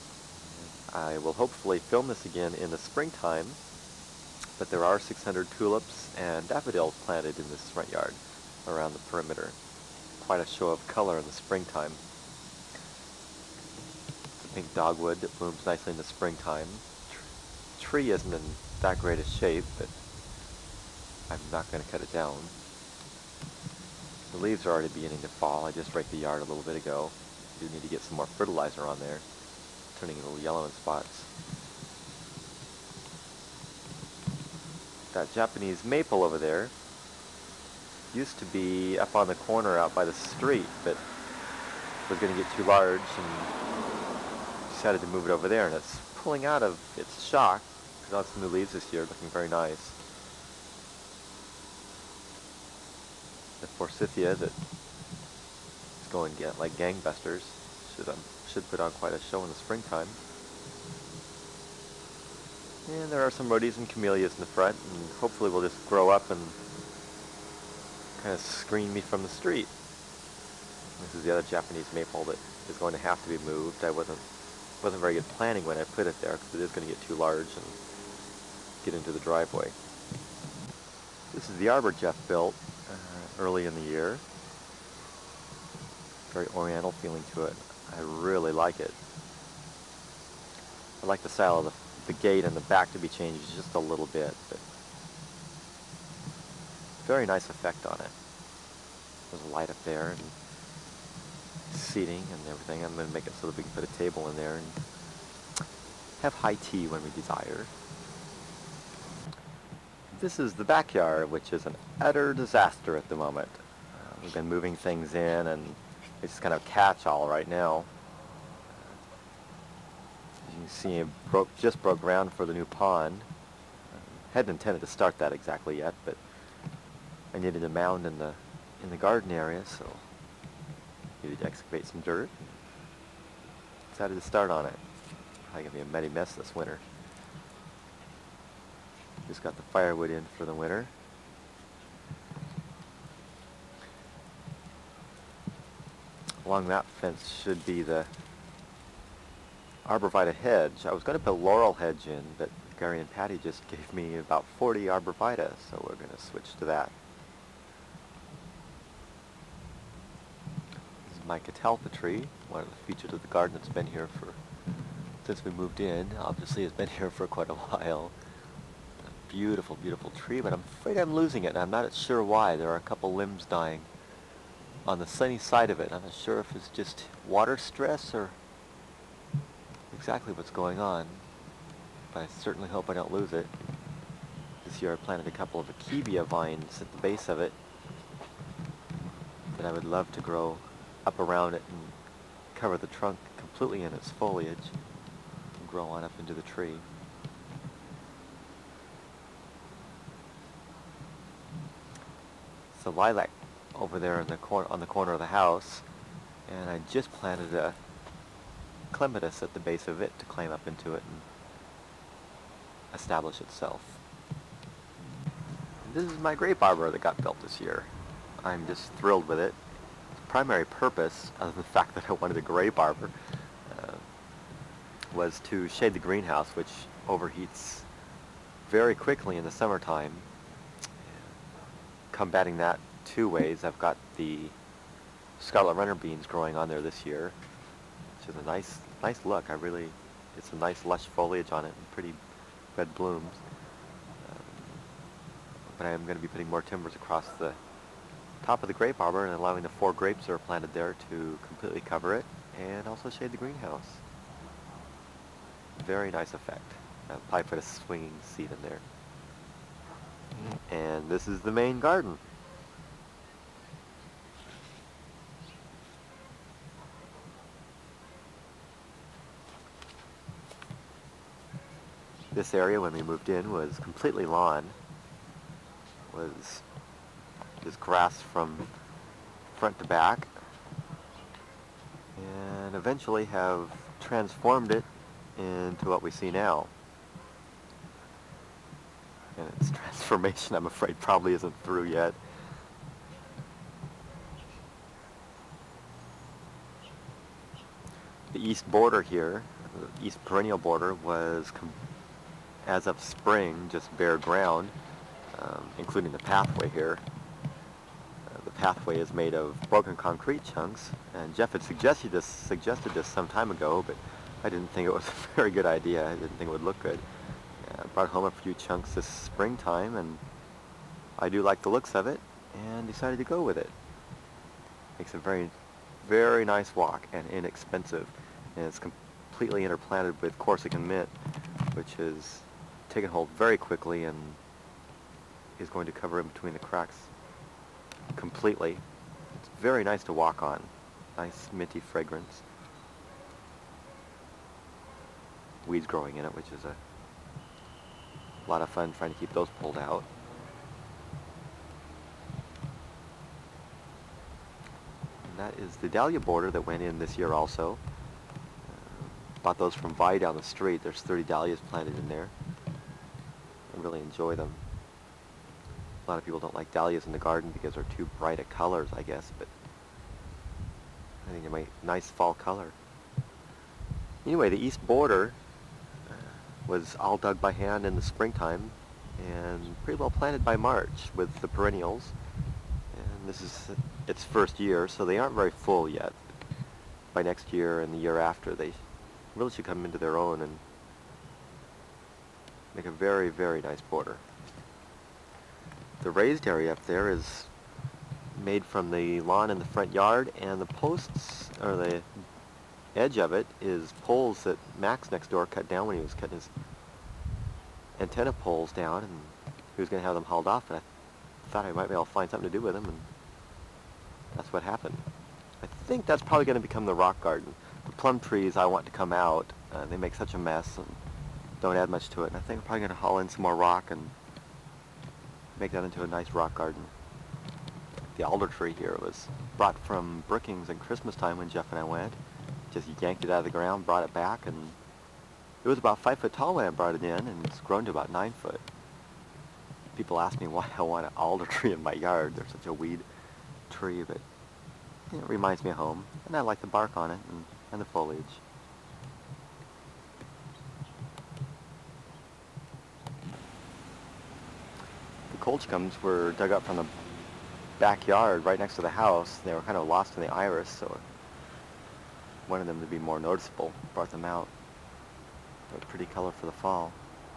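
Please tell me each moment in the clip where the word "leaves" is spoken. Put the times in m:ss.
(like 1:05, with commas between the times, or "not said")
0:24, 0:48.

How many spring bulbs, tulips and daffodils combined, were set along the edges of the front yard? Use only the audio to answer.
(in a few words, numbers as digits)
600.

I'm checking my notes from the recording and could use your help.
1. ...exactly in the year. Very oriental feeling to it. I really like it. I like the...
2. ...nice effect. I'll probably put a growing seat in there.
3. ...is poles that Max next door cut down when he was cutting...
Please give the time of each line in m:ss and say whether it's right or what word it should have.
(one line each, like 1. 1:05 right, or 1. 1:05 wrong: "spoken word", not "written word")
1. 1:23 wrong: "early", not "exactly"
2. 4:16 wrong: "swinging", not "growing"
3. 6:43 right.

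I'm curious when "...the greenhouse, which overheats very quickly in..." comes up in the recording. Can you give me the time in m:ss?
3:45.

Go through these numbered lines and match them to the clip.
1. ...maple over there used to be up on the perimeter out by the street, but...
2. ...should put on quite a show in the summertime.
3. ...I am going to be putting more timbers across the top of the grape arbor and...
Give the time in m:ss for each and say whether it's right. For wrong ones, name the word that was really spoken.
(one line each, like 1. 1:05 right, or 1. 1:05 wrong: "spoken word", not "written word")
1. 0:35 wrong: "corner", not "perimeter"
2. 0:58 wrong: "springtime", not "summertime"
3. 4:05 right.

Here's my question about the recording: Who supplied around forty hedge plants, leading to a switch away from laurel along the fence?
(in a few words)
Gary and Patty.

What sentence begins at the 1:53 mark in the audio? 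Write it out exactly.
Uh, we've been moving things in and it's kind of catch-all right now.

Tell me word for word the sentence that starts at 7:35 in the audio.
Colchicums were dug up from the backyard right next to the house.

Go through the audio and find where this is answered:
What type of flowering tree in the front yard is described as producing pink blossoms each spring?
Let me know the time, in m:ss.
0:14.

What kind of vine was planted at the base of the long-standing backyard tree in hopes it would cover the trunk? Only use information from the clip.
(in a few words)
Akebia.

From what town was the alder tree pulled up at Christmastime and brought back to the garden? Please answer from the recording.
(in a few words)
Brookings.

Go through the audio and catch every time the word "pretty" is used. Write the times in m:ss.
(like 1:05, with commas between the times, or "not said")
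4:01, 6:19, 7:45.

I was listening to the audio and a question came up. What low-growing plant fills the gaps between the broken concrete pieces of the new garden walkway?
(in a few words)
Corsican mint.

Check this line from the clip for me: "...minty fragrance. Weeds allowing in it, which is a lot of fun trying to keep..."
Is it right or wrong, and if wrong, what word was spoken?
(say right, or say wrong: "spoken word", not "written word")
wrong: "growing", not "allowing".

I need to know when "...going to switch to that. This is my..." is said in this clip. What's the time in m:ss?
2:35.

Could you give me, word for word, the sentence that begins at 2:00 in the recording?
You see it broke, just broke ground for the new pond.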